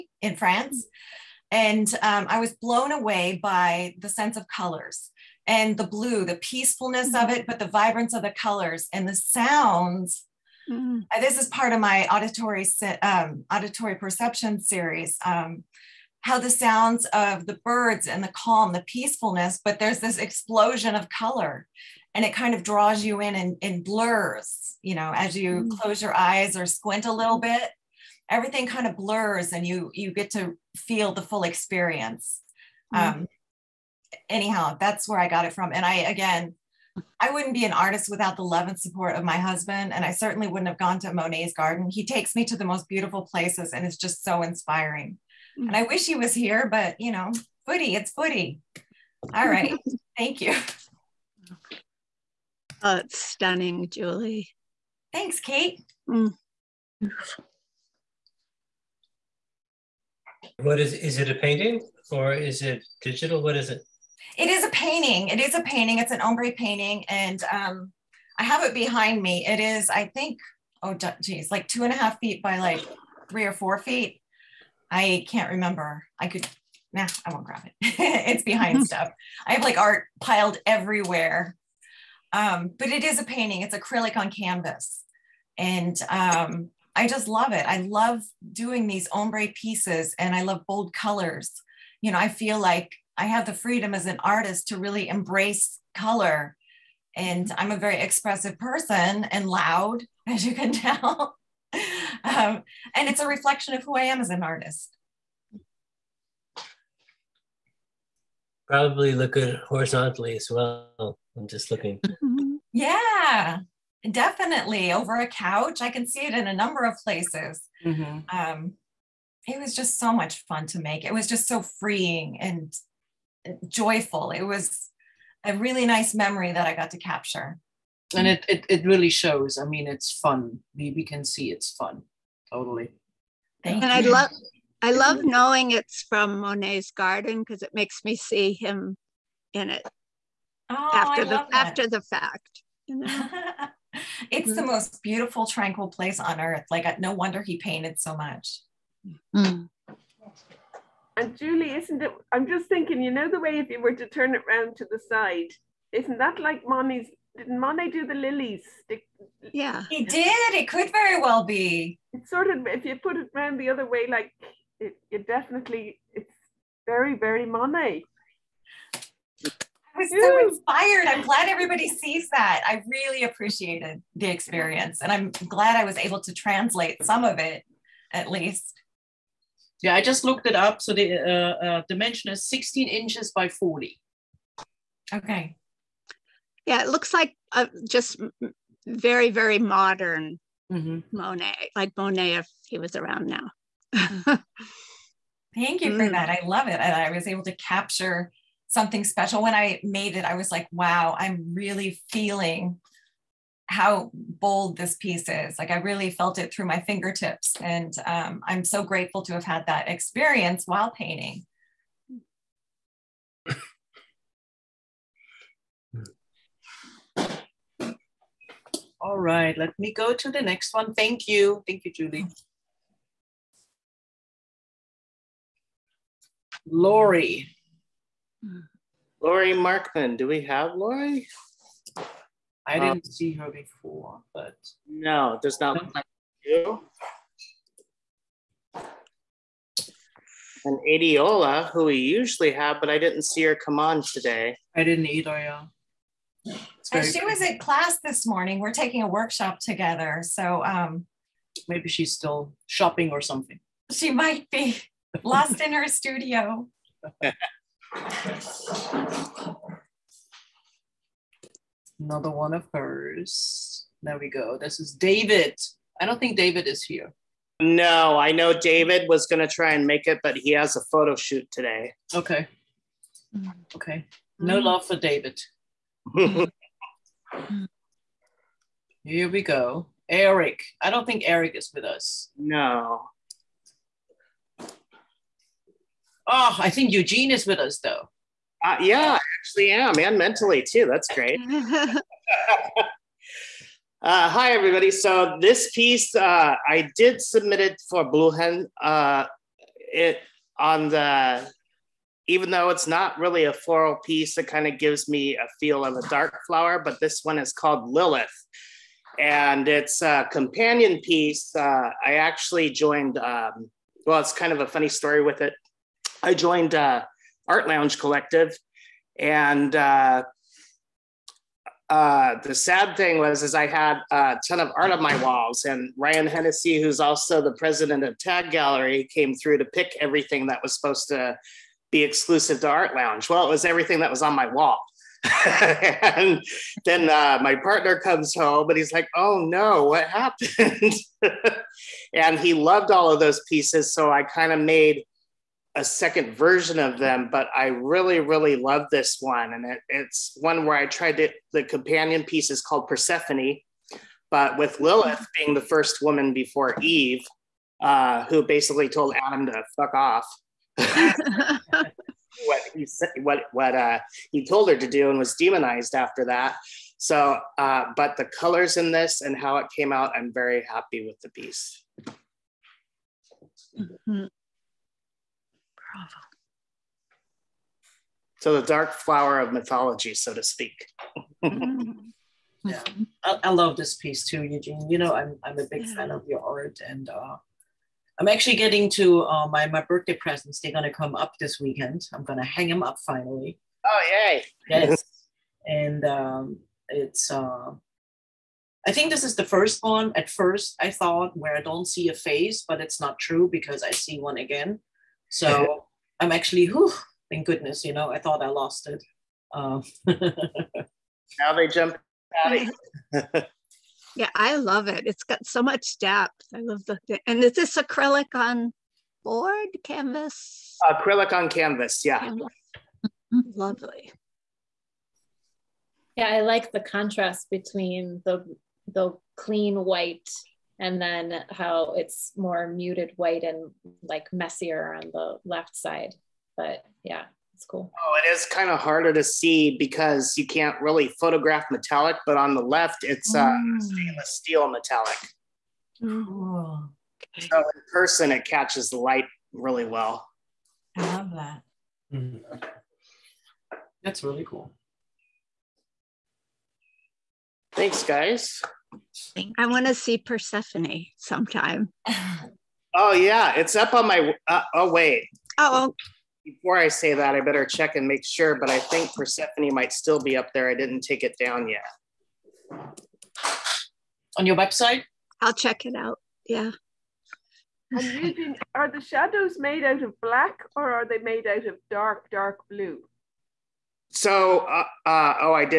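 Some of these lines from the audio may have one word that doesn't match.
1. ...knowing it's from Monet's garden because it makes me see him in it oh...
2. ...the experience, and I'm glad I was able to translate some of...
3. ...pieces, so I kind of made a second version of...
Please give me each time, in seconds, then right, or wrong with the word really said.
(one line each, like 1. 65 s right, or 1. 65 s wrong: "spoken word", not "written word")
1. 135 s right
2. 174 s right
3. 343 s right.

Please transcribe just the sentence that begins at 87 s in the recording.
I love doing these ombre pieces and I love bold colors.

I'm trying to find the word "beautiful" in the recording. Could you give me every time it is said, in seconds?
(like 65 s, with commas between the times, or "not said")
42 s, 145 s.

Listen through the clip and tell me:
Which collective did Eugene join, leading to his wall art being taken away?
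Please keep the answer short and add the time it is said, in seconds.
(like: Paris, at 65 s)
Art Lounge Collective, at 317 s.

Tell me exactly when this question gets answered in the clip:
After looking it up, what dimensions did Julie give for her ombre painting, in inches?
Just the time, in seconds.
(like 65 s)
182 s.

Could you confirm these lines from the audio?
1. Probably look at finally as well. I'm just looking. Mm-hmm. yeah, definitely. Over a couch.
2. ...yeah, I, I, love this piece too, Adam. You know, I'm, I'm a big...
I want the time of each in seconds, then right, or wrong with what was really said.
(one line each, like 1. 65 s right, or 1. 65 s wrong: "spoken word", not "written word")
1. 108 s wrong: "horizontally", not "finally"
2. 381 s wrong: "Eugene", not "Adam".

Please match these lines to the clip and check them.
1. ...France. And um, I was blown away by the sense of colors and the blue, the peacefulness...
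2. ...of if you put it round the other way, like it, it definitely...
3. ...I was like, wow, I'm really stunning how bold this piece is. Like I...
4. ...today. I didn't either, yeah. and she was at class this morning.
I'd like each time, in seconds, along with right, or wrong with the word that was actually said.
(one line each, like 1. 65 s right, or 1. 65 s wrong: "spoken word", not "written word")
1. 0 s right
2. 162 s right
3. 200 s wrong: "feeling", not "stunning"
4. 244 s right.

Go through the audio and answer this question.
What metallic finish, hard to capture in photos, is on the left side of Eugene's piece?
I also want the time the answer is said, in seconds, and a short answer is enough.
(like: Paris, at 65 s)
Stainless steel metallic, at 443 s.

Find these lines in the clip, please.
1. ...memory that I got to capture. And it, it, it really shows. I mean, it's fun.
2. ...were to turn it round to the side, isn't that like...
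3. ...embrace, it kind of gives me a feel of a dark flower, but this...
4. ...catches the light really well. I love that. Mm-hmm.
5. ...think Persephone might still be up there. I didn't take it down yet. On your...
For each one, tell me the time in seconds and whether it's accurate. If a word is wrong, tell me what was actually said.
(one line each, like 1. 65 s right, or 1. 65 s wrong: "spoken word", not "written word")
1. 126 s right
2. 153 s right
3. 304 s wrong: "piece", not "embrace"
4. 448 s right
5. 468 s right.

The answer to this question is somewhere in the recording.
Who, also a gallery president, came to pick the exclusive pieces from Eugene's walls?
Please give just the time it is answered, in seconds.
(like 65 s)
325 s.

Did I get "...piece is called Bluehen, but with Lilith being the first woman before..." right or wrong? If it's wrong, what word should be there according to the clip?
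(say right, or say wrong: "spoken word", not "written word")
wrong: "Persephone", not "Bluehen".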